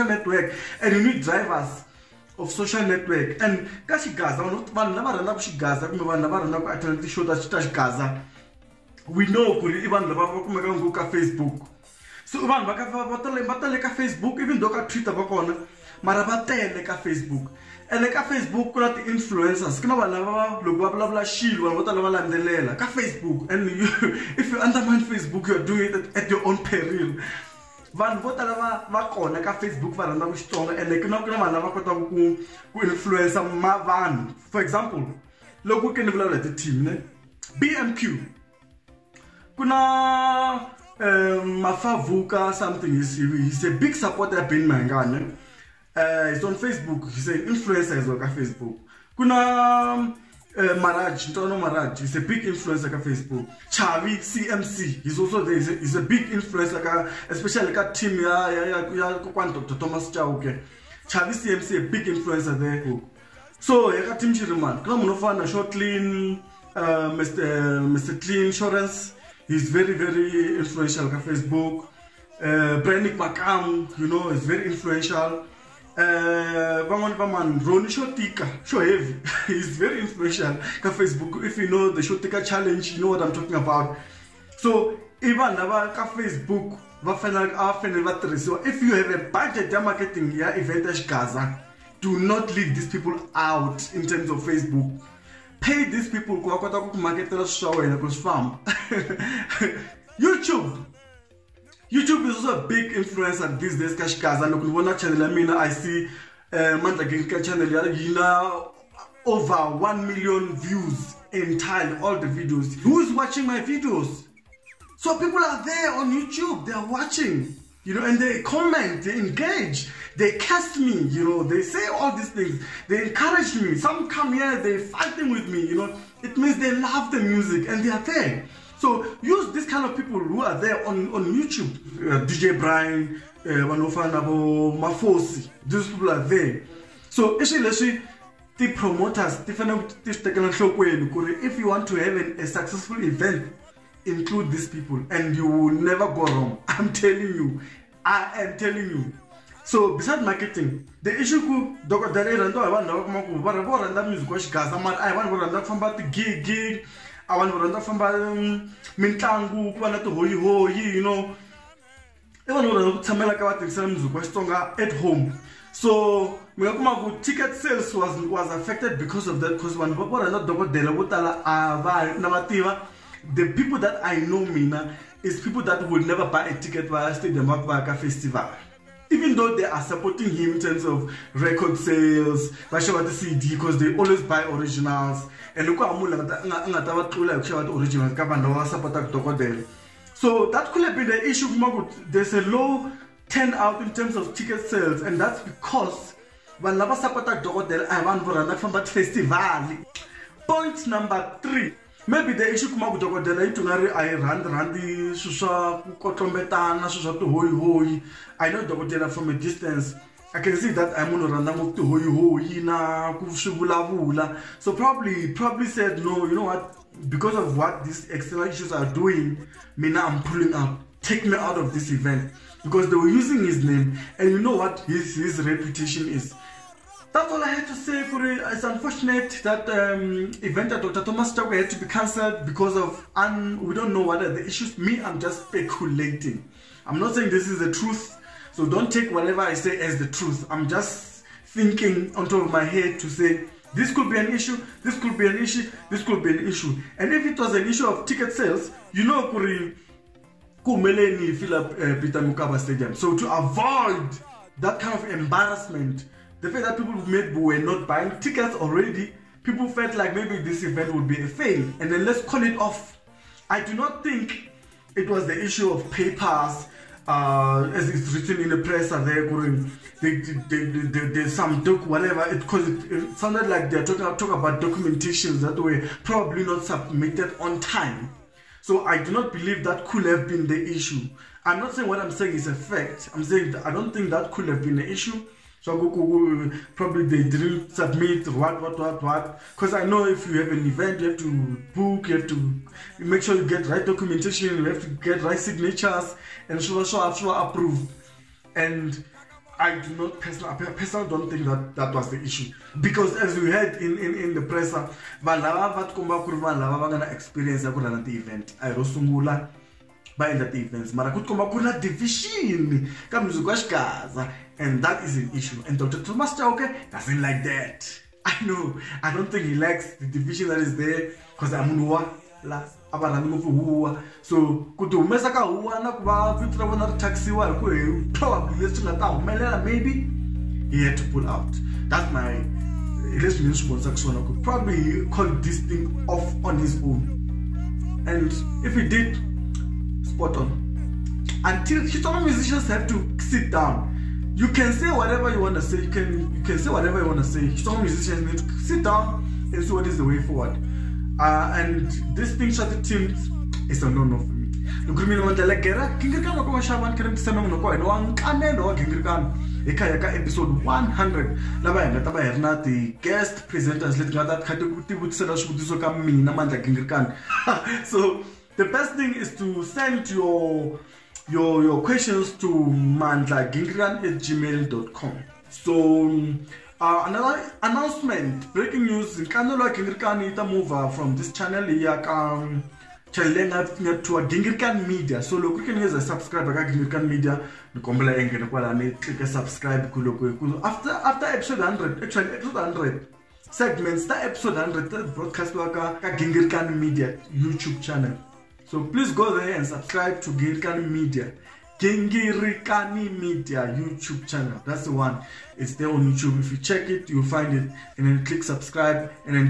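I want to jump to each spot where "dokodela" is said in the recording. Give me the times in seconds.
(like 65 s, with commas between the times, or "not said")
151 s, 170 s, 197 s, 202 s, 208 s.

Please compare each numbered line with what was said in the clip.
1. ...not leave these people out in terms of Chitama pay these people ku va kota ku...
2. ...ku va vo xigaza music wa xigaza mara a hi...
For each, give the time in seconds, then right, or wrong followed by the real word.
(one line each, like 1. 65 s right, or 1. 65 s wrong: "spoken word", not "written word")
1. 92 s wrong: "Facebook", not "Chitama"
2. 153 s wrong: "rhandza", not "xigaza".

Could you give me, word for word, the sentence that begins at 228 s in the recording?
It's unfortunate that um, event at Dr.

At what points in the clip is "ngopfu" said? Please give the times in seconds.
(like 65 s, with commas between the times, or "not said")
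10 s, 211 s, 323 s.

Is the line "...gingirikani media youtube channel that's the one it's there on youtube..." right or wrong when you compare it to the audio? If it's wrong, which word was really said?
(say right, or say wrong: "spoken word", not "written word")
right.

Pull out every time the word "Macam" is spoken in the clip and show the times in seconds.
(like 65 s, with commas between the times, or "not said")
73 s.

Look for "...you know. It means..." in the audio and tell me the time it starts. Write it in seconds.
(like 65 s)
125 s.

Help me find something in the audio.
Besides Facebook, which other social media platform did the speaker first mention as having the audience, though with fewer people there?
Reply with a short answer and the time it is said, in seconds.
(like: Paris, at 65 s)
Twitter, at 14 s.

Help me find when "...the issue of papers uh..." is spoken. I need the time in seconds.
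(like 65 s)
265 s.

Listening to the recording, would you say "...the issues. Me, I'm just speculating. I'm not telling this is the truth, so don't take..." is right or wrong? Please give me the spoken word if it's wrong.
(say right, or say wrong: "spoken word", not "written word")
wrong: "saying", not "telling".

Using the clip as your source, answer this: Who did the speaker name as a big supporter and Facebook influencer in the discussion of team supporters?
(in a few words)
Ben Mangane.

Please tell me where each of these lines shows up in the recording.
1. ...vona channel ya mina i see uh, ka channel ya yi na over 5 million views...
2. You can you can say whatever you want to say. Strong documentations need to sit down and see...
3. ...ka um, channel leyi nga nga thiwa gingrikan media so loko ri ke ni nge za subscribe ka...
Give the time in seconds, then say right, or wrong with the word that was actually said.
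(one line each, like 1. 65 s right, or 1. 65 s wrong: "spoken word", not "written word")
1. 104 s wrong: "1", not "5"
2. 345 s wrong: "musicians", not "documentations"
3. 382 s right.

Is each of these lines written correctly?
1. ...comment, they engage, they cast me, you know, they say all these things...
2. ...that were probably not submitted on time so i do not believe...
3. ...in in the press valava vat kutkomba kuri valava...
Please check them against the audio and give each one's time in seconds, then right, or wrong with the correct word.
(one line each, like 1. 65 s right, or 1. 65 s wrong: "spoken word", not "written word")
1. 118 s right
2. 275 s right
3. 303 s wrong: "komba", not "kutkomba".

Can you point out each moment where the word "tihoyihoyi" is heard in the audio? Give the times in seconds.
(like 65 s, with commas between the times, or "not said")
160 s, 207 s, 211 s.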